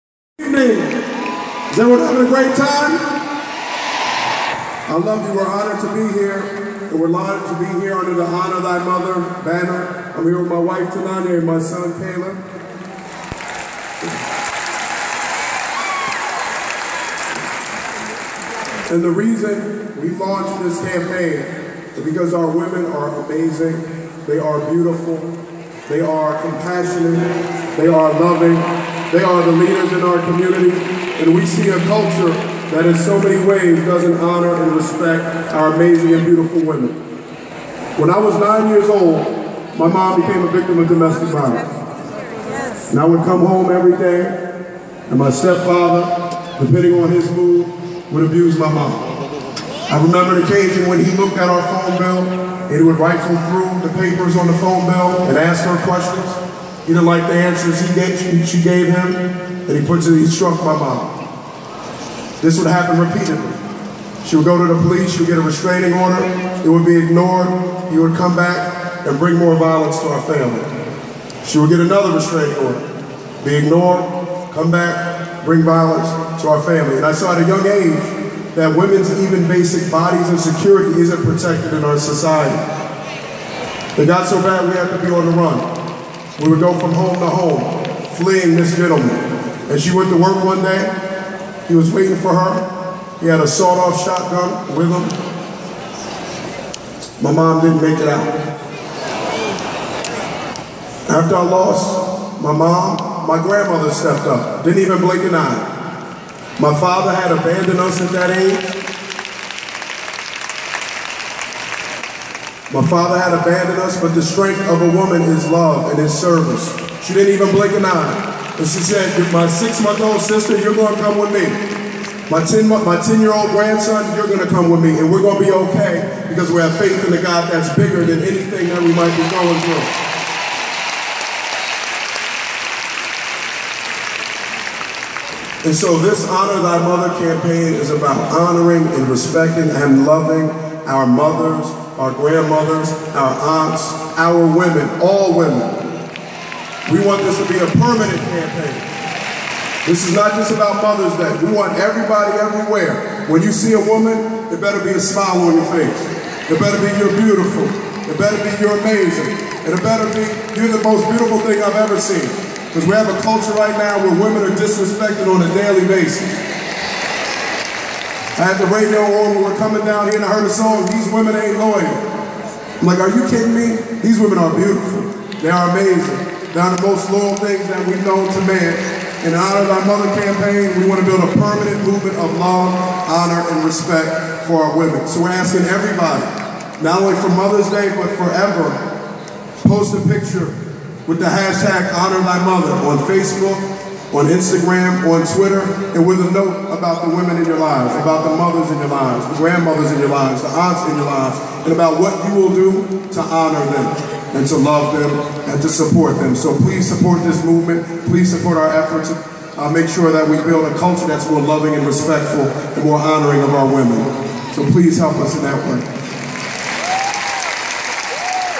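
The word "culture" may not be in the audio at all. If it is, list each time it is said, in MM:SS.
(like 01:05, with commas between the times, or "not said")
00:31, 02:43, 03:30.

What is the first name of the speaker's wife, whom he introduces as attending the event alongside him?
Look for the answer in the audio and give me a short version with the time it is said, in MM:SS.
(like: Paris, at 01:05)
Tanania, at 00:10.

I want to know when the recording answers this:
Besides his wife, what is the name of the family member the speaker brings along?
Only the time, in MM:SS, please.
00:11.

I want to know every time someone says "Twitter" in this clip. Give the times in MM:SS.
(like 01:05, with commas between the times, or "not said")
03:15.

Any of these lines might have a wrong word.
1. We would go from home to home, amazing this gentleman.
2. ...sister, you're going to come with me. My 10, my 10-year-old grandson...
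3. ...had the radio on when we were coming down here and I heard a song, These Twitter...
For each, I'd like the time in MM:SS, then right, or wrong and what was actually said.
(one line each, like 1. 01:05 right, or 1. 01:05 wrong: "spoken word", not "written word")
1. 01:26 wrong: "fleeing", not "amazing"
2. 02:00 right
3. 02:48 wrong: "Women", not "Twitter".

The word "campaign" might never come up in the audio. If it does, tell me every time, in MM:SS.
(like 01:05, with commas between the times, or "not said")
00:20, 02:17, 02:28, 03:00.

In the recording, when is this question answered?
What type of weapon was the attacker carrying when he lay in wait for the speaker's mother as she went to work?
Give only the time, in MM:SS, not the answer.
01:33.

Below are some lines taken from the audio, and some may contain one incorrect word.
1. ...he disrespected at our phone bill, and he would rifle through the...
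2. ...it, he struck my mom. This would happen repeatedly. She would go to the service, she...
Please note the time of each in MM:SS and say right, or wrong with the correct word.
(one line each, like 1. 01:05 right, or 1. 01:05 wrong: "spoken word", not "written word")
1. 00:51 wrong: "looked", not "disrespected"
2. 01:00 wrong: "police", not "service".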